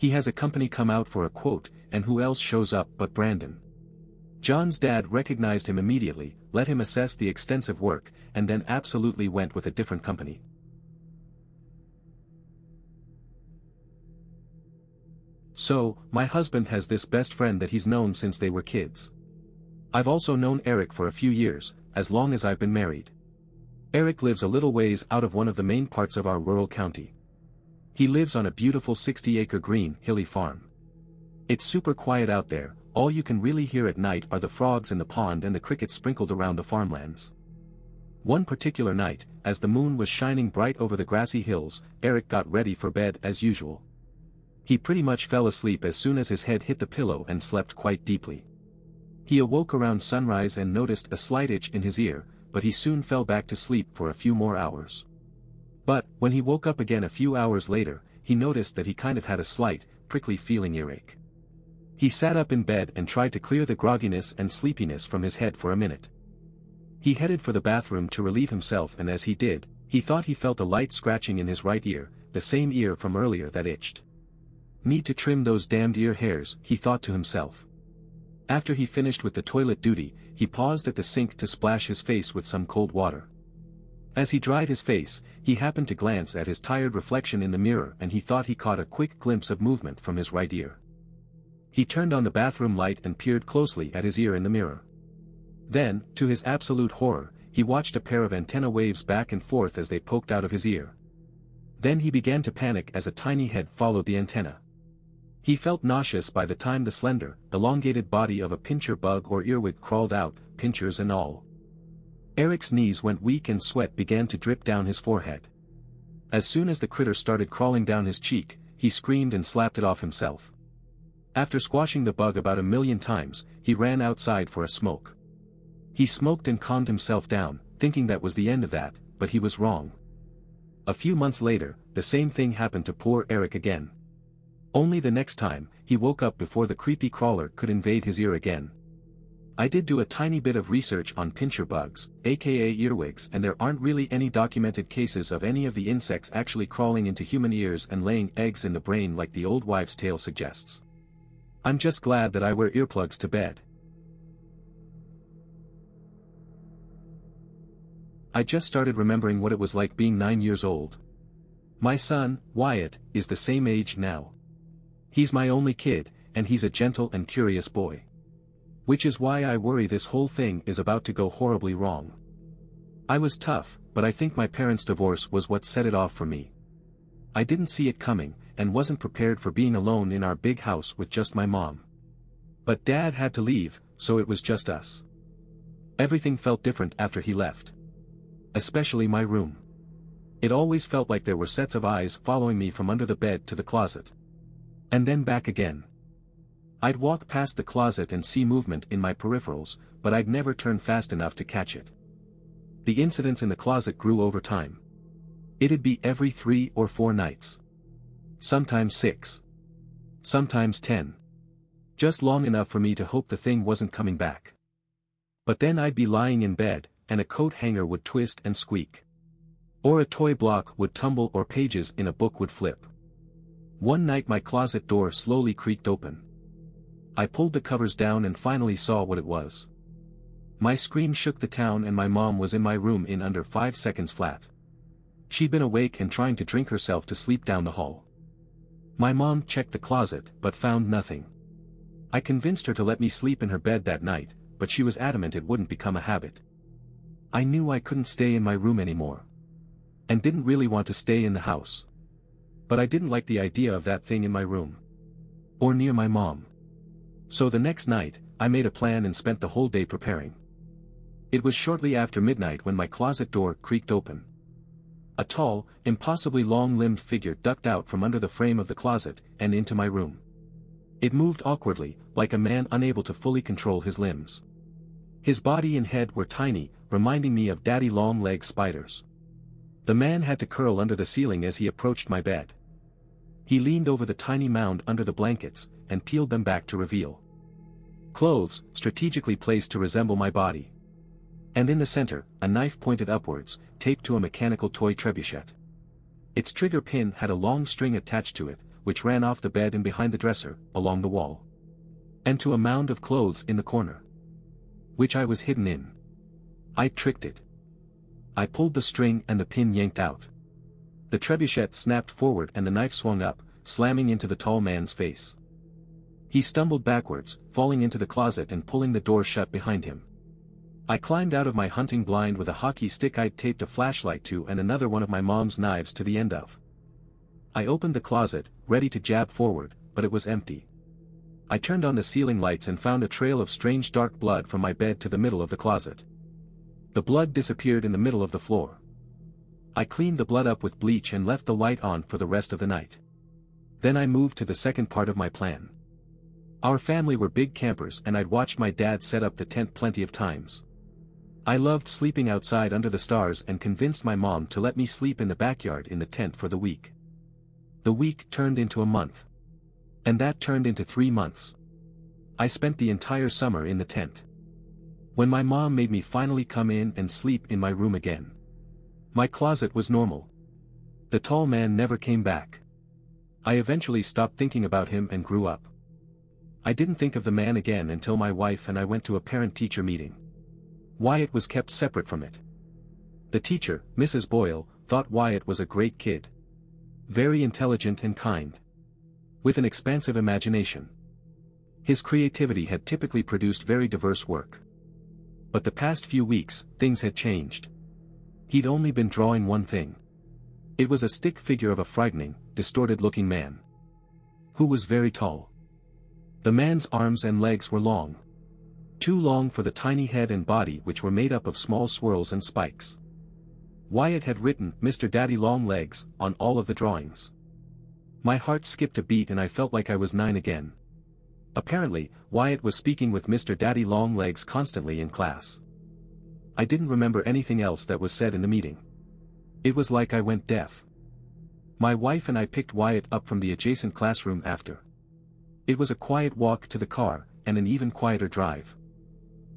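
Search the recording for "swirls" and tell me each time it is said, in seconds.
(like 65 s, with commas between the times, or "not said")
411 s.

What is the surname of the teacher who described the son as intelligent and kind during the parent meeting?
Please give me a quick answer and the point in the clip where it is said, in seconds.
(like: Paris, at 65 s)
Boyle, at 383 s.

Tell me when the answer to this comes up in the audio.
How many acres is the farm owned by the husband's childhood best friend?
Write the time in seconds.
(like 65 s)
28 s.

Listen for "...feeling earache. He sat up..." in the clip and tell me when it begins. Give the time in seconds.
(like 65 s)
60 s.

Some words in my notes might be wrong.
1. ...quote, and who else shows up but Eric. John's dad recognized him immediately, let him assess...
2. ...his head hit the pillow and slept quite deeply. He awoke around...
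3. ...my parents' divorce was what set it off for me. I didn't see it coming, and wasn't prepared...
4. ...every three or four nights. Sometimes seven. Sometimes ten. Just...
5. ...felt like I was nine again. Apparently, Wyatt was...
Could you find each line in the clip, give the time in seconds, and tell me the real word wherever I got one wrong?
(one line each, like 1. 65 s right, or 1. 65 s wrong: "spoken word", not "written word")
1. 1 s wrong: "Brandon", not "Eric"
2. 46 s right
3. 174 s right
4. 206 s wrong: "six", not "seven"
5. 419 s right.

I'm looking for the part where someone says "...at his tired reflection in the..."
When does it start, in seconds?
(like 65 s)
86 s.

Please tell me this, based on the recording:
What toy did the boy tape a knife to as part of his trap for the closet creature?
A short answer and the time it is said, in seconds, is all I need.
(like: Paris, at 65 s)
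Mechanical toy trebuchet, at 294 s.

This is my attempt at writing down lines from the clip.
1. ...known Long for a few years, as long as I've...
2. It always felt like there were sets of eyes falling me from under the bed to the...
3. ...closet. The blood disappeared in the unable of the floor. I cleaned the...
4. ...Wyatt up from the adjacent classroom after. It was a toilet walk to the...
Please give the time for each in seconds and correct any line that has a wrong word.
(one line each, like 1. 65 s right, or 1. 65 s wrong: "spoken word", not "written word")
1. 20 s wrong: "Eric", not "Long"
2. 190 s wrong: "following", not "falling"
3. 335 s wrong: "middle", not "unable"
4. 432 s wrong: "quiet", not "toilet".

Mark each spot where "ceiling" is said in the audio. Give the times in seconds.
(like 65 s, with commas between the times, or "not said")
281 s, 332 s.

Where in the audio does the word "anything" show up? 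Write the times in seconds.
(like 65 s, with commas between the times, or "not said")
427 s.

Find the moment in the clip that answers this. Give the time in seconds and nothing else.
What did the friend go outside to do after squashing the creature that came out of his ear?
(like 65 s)
124 s.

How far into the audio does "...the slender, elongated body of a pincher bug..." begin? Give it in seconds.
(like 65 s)
106 s.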